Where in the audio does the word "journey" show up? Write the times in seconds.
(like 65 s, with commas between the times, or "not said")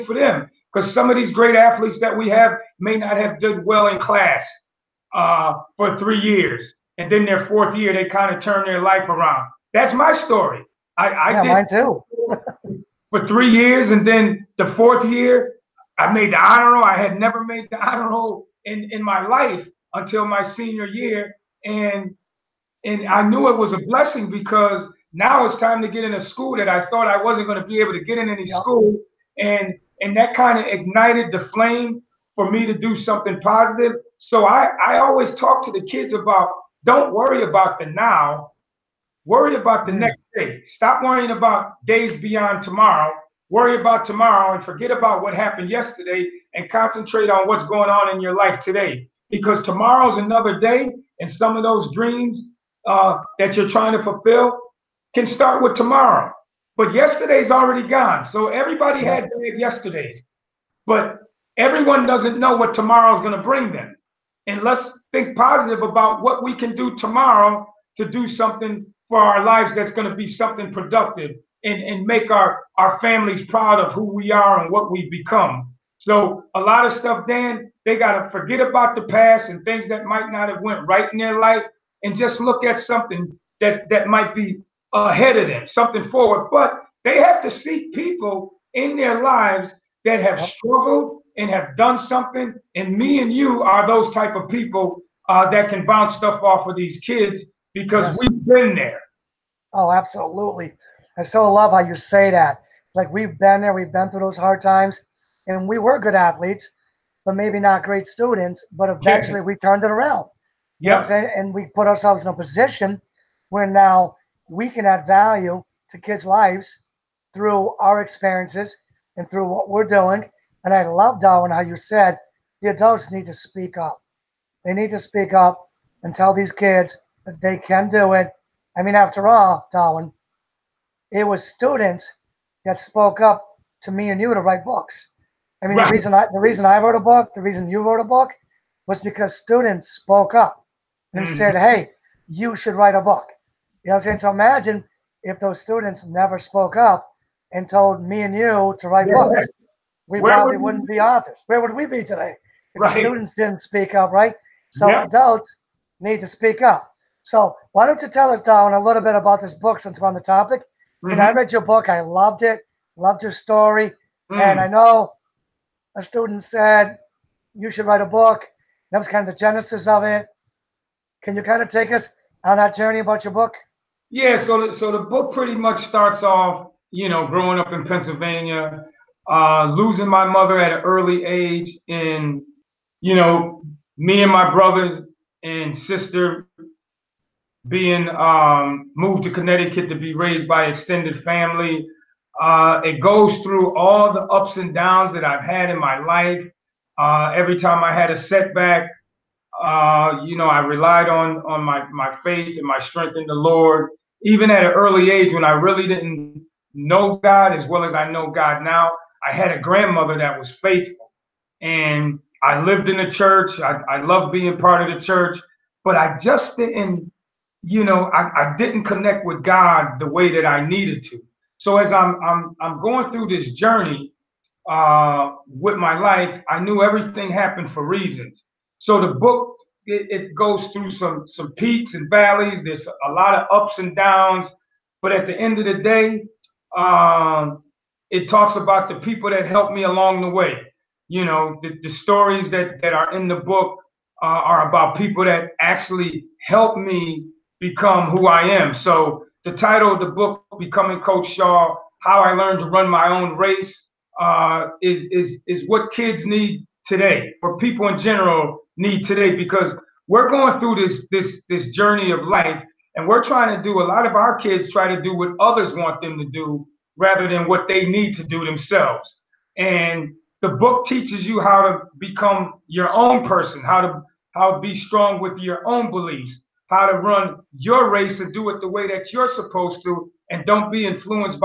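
172 s, 223 s, 261 s.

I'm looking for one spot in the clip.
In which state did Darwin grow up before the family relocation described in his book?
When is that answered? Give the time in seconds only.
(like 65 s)
177 s.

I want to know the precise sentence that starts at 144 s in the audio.
So imagine if those students never spoke up and told me and you to write yeah.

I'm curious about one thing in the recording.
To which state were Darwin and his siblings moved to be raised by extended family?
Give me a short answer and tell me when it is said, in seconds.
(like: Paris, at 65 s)
Connecticut, at 189 s.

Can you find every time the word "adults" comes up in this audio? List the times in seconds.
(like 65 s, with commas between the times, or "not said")
122 s, 155 s.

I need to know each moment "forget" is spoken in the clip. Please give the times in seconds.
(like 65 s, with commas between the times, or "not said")
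44 s, 78 s.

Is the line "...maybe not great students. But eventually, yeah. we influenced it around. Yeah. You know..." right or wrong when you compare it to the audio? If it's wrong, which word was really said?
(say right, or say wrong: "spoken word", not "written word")
wrong: "turned", not "influenced".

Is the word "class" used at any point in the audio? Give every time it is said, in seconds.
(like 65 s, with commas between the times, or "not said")
3 s.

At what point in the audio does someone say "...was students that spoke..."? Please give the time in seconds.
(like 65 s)
131 s.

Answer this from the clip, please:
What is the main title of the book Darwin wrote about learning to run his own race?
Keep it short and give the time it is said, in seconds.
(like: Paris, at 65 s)
Becoming Coach Shaw, at 250 s.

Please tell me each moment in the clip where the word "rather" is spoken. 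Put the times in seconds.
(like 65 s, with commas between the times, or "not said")
266 s.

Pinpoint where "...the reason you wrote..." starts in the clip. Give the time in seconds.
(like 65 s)
137 s.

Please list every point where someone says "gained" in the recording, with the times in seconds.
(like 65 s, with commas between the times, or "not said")
not said.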